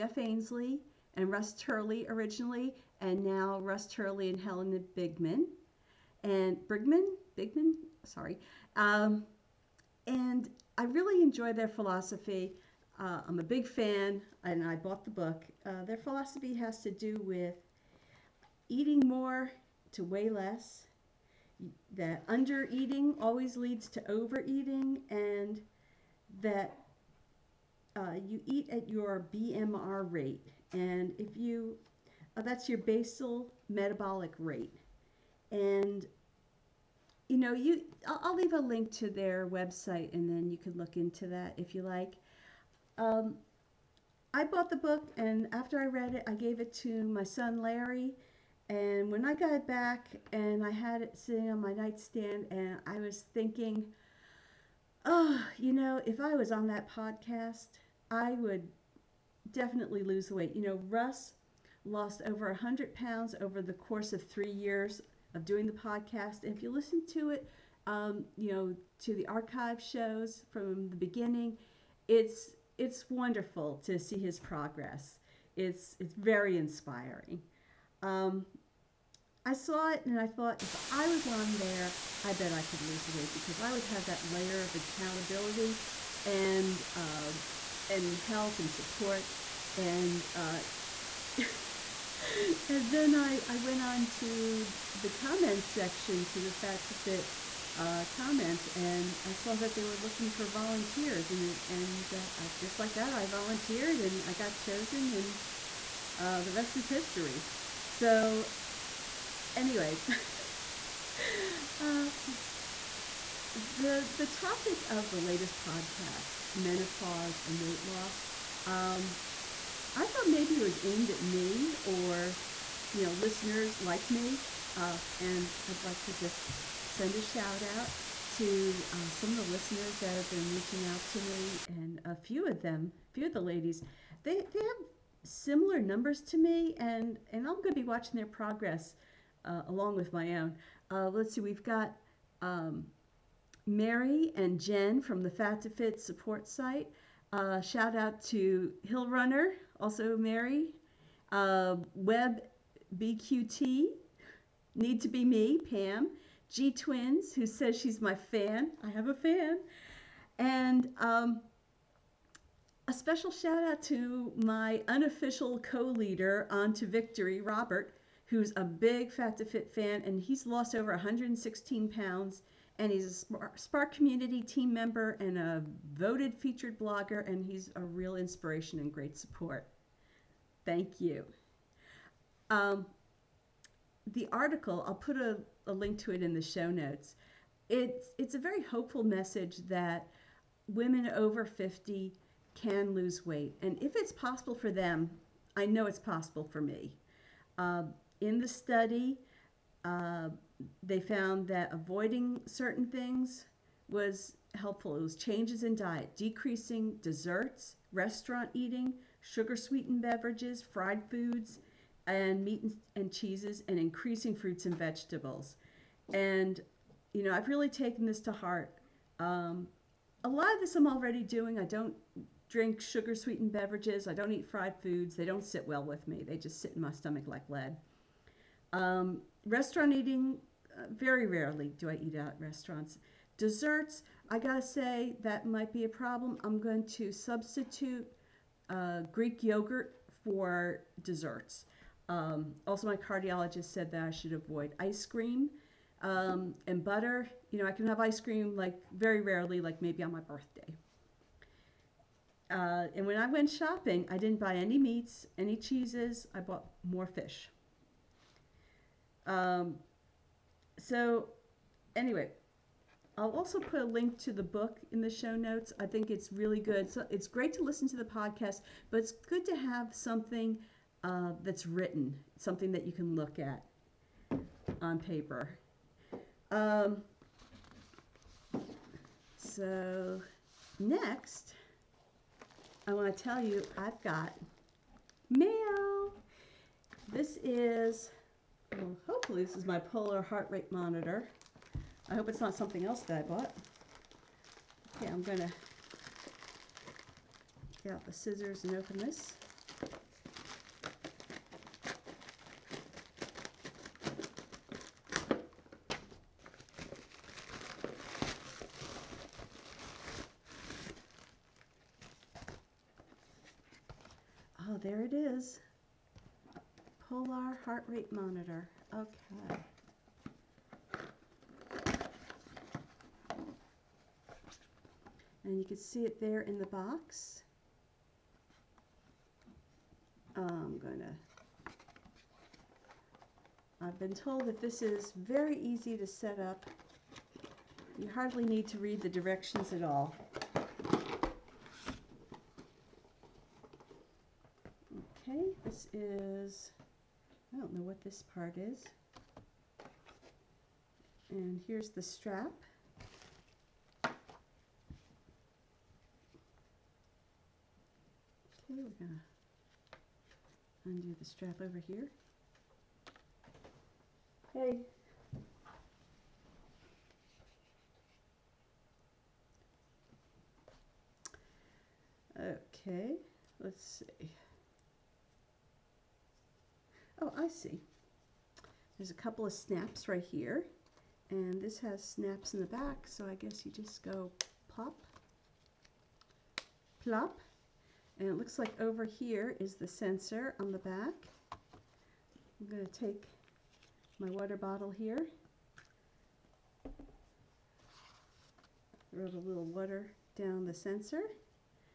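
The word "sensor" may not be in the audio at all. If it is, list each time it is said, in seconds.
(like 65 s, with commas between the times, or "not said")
389 s, 400 s.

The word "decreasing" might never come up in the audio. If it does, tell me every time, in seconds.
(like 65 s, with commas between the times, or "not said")
206 s.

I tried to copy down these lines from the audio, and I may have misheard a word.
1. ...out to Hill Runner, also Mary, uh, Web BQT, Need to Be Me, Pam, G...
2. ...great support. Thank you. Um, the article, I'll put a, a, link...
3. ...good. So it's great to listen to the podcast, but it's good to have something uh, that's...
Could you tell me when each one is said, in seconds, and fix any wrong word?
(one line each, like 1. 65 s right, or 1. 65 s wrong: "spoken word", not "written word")
1. 147 s right
2. 178 s right
3. 266 s right.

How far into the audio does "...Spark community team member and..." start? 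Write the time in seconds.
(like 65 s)
173 s.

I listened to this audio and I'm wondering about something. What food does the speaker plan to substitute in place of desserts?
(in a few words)
Greek yogurt.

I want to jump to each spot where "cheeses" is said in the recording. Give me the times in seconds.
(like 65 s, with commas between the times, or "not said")
213 s, 255 s.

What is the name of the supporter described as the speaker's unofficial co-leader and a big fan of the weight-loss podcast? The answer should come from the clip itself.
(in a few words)
Robert.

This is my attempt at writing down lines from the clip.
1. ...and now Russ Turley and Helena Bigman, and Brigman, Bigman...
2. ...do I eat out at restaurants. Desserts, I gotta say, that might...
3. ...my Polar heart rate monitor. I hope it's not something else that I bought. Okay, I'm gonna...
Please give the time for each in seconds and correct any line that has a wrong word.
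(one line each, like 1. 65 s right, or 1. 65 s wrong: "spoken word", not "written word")
1. 3 s right
2. 231 s right
3. 289 s right.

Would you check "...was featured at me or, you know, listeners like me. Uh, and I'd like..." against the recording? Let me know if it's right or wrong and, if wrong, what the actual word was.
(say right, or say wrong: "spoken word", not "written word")
wrong: "aimed", not "featured".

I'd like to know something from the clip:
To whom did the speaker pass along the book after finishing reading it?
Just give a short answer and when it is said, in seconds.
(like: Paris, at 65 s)
Larry, at 47 s.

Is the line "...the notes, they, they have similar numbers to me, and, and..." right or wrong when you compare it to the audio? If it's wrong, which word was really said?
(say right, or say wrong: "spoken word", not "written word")
wrong: "ladies", not "notes".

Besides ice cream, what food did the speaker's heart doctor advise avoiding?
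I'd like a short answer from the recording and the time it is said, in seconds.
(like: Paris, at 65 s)
butter, at 246 s.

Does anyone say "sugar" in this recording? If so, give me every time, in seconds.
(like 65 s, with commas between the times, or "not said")
209 s, 222 s.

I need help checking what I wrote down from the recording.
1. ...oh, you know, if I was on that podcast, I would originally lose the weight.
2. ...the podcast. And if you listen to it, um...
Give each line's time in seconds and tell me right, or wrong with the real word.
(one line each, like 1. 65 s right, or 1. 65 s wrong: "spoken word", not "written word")
1. 55 s wrong: "definitely", not "originally"
2. 65 s right.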